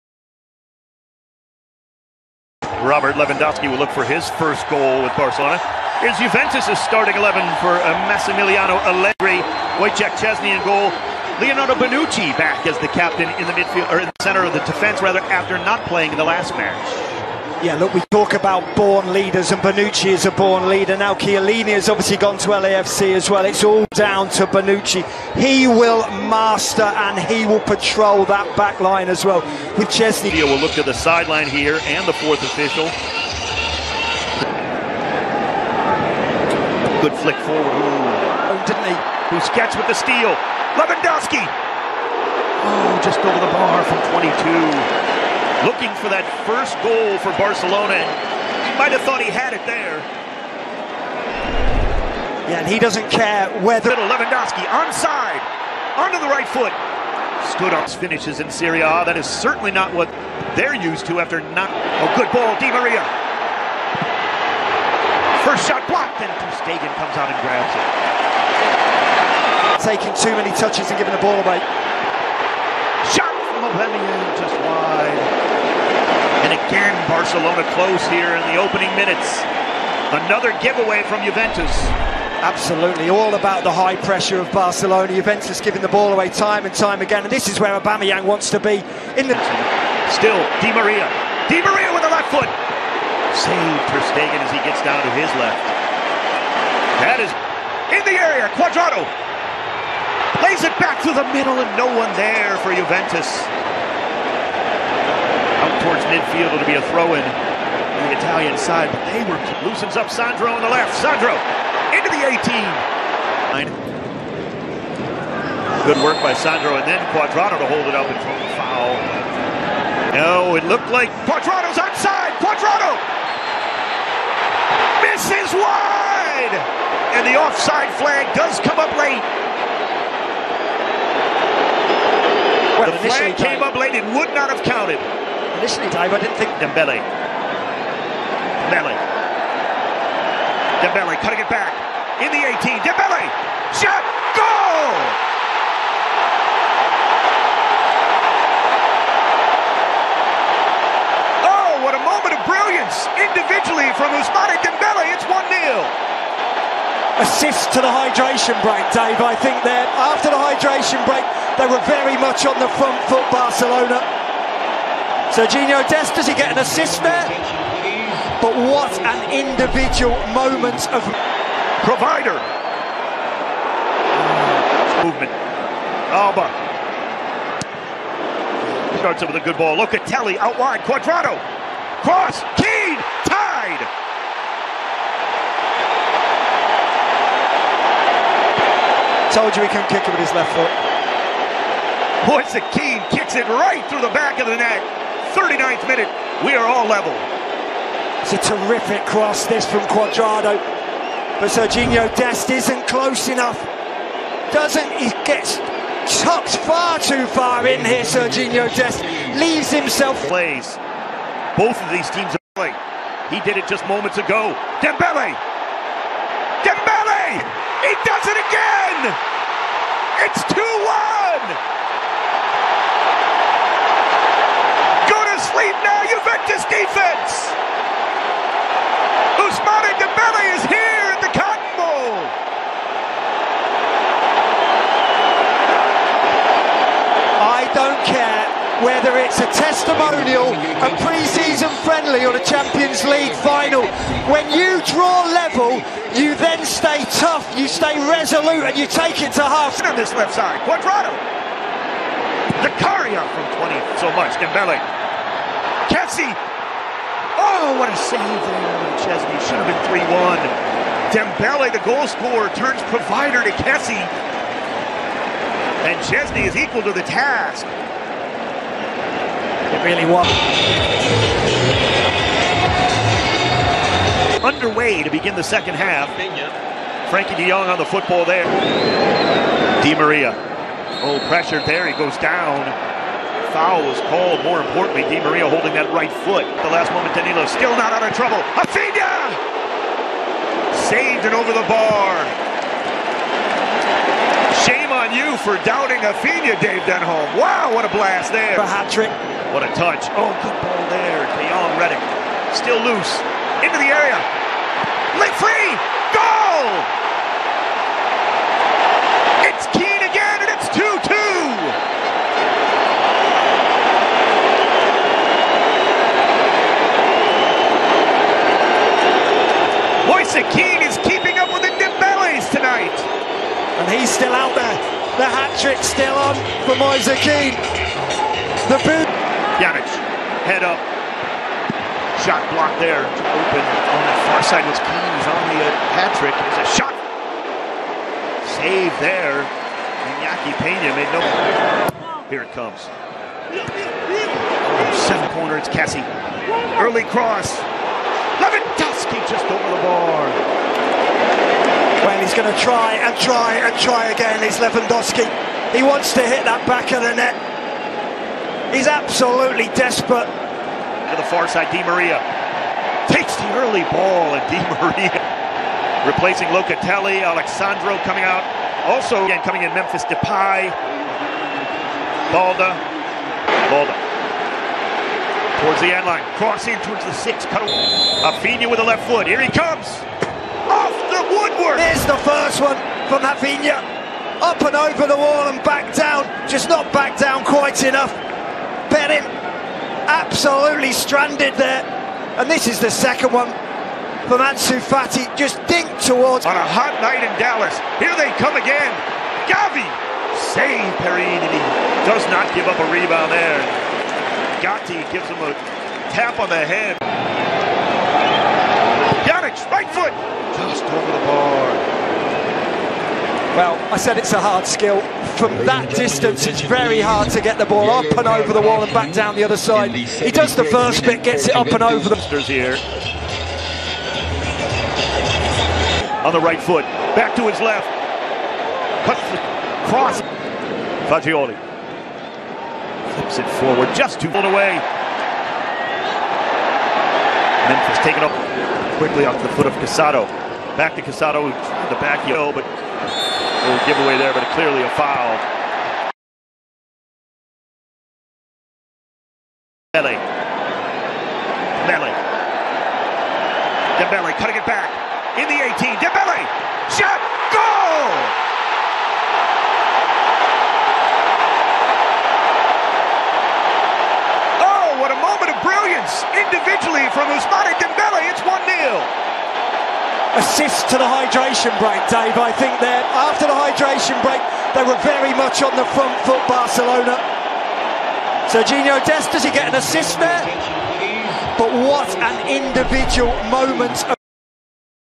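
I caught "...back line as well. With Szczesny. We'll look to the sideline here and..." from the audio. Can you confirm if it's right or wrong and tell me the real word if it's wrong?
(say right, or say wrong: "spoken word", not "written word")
right.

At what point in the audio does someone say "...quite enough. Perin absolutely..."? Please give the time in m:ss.
6:27.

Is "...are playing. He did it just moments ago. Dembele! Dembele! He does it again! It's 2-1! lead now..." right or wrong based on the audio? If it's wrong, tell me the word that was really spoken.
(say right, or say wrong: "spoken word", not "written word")
right.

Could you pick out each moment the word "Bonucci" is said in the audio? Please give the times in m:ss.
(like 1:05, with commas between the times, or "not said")
0:11, 0:19, 0:24.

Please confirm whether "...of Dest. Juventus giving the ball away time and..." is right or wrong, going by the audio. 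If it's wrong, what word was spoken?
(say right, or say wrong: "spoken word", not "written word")
wrong: "Barcelona", not "Dest".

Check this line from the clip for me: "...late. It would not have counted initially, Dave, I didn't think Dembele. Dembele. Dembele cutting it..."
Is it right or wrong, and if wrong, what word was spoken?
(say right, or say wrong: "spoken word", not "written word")
right.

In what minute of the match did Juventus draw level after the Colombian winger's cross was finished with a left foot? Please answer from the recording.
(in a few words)
39th.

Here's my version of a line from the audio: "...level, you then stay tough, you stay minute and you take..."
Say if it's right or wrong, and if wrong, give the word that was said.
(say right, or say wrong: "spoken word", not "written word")
wrong: "resolute", not "minute".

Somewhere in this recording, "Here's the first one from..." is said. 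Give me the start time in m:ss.
6:21.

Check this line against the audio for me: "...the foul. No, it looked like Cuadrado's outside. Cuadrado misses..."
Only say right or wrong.
right.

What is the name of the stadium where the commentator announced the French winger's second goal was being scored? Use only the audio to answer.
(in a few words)
Cotton Bowl.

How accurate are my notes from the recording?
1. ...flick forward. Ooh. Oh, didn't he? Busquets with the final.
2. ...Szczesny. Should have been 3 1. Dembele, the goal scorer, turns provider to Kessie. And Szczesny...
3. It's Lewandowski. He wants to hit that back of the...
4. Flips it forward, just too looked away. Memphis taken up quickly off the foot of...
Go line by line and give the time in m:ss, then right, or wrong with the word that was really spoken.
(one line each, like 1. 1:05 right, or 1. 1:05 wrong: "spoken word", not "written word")
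1. 0:37 wrong: "steal", not "final"
2. 4:19 right
3. 5:54 right
4. 7:13 wrong: "pulled", not "looked".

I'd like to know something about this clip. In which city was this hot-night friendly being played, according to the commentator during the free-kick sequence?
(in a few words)
Dallas.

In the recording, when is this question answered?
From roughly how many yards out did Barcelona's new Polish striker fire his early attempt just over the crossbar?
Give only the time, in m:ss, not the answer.
0:44.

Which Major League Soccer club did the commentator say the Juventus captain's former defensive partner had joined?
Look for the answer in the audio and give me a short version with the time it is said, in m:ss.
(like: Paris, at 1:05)
LAFC, at 0:22.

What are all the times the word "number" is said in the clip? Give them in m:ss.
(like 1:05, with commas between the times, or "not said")
not said.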